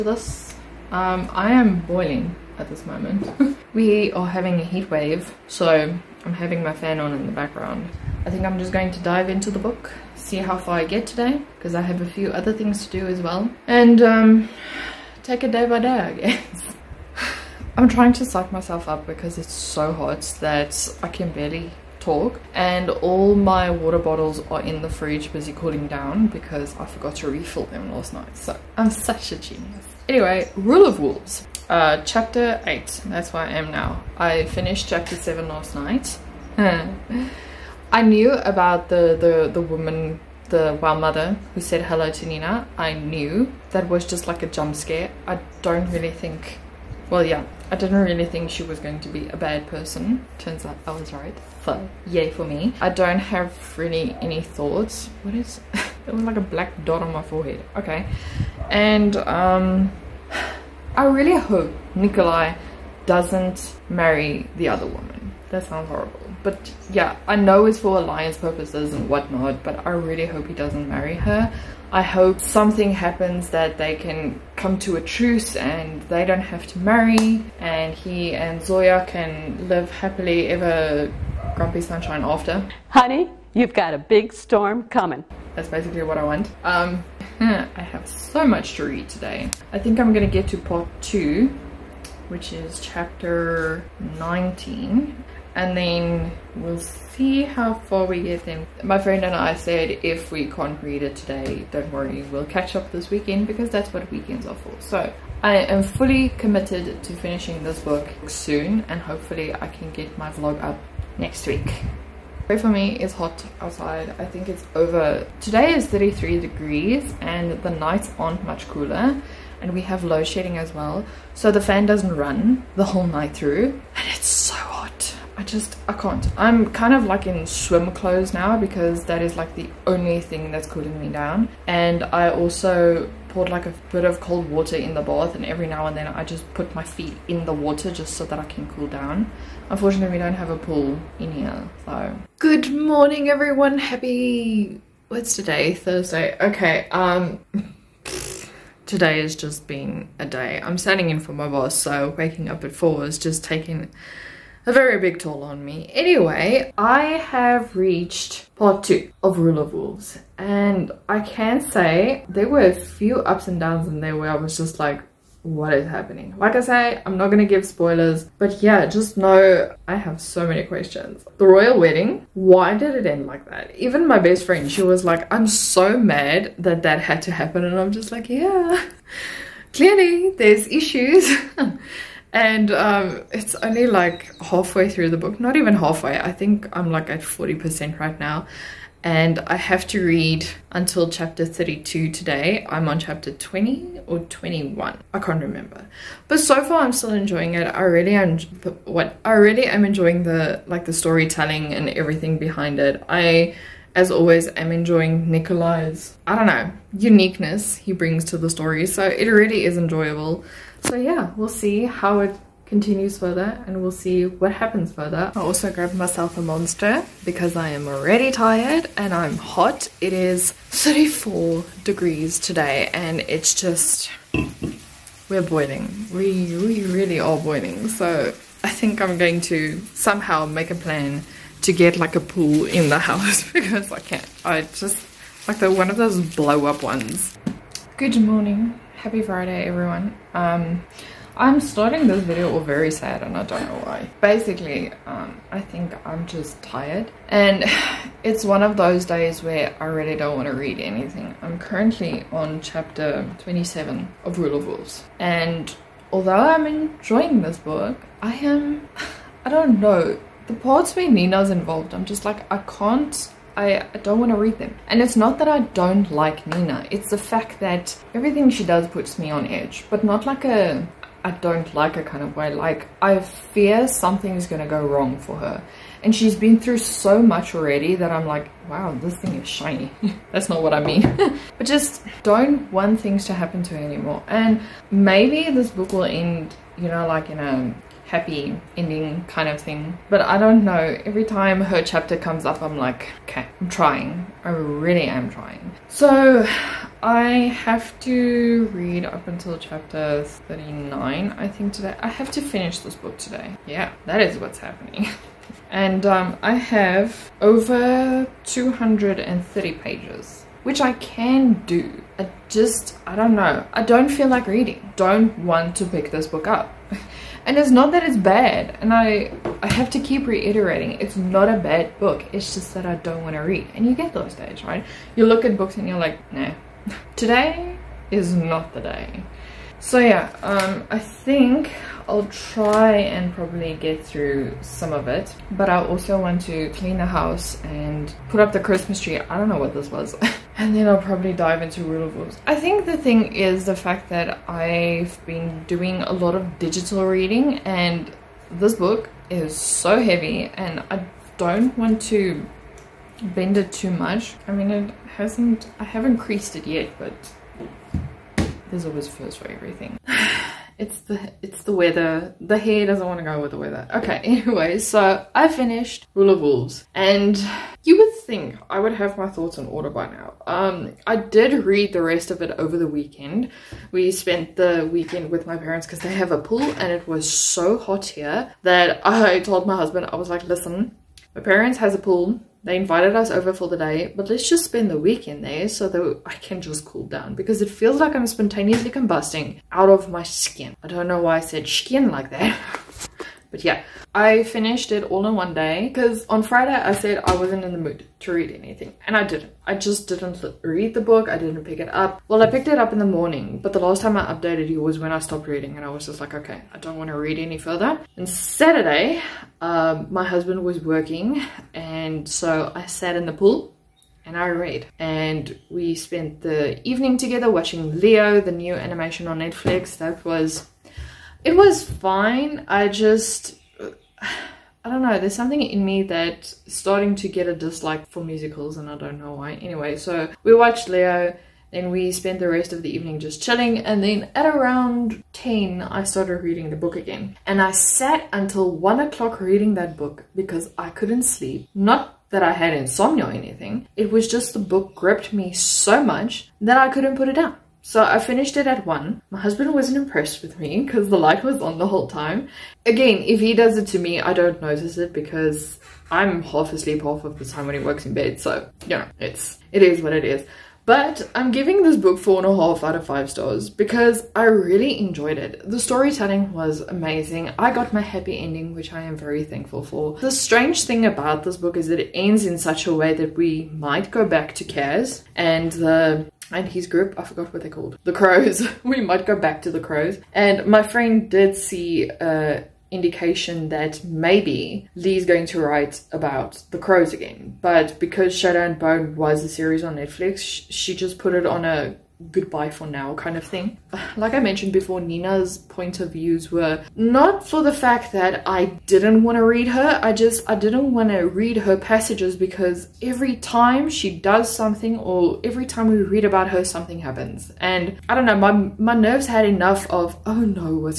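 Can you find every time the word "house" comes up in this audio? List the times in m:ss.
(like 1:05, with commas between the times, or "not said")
3:52, 5:37.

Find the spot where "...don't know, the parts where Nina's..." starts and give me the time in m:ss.
4:19.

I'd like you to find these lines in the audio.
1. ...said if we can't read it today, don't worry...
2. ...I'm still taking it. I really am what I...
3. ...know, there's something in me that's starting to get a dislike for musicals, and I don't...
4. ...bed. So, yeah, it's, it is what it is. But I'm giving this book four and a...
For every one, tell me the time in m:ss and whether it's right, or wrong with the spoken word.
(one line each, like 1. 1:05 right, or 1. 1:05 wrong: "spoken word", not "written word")
1. 1:39 right
2. 3:16 wrong: "enjoying", not "taking"
3. 7:05 right
4. 7:38 right.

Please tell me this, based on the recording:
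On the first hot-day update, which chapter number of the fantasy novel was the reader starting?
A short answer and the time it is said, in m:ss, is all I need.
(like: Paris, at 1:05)
8, at 0:32.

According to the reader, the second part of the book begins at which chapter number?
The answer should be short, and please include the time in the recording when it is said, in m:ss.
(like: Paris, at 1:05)
19, at 1:32.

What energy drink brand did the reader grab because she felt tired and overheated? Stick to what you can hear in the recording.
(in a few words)
Monster.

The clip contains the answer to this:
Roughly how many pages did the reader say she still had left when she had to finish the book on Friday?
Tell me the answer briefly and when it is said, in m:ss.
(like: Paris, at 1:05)
230, at 5:08.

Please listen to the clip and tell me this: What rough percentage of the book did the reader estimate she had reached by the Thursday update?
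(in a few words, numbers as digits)
40%.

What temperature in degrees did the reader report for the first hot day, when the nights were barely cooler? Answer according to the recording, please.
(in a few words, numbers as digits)
33.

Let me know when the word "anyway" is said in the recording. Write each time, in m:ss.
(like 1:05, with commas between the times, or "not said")
0:30, 2:35, 6:04, 7:09.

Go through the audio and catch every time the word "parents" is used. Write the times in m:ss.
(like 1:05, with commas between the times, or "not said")
6:15, 6:21.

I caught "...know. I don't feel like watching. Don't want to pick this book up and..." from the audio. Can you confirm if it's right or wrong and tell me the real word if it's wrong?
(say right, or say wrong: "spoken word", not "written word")
wrong: "reading", not "watching".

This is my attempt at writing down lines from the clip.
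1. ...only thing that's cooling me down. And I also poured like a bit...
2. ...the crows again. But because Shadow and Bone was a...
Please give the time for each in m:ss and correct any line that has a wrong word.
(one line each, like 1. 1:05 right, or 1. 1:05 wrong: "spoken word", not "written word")
1. 2:09 right
2. 8:06 right.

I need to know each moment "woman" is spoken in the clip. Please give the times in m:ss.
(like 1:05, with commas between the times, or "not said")
0:39, 1:04.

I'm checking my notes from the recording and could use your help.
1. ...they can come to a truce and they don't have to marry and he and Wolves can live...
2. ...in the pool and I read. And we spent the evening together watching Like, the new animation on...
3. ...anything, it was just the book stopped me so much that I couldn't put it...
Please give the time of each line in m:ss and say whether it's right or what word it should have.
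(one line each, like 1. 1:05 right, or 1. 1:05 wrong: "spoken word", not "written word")
1. 1:13 wrong: "Zoya", not "Wolves"
2. 6:53 wrong: "Leo", not "Like"
3. 7:23 wrong: "gripped", not "stopped".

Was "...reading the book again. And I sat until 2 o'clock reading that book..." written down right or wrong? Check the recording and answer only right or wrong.
wrong.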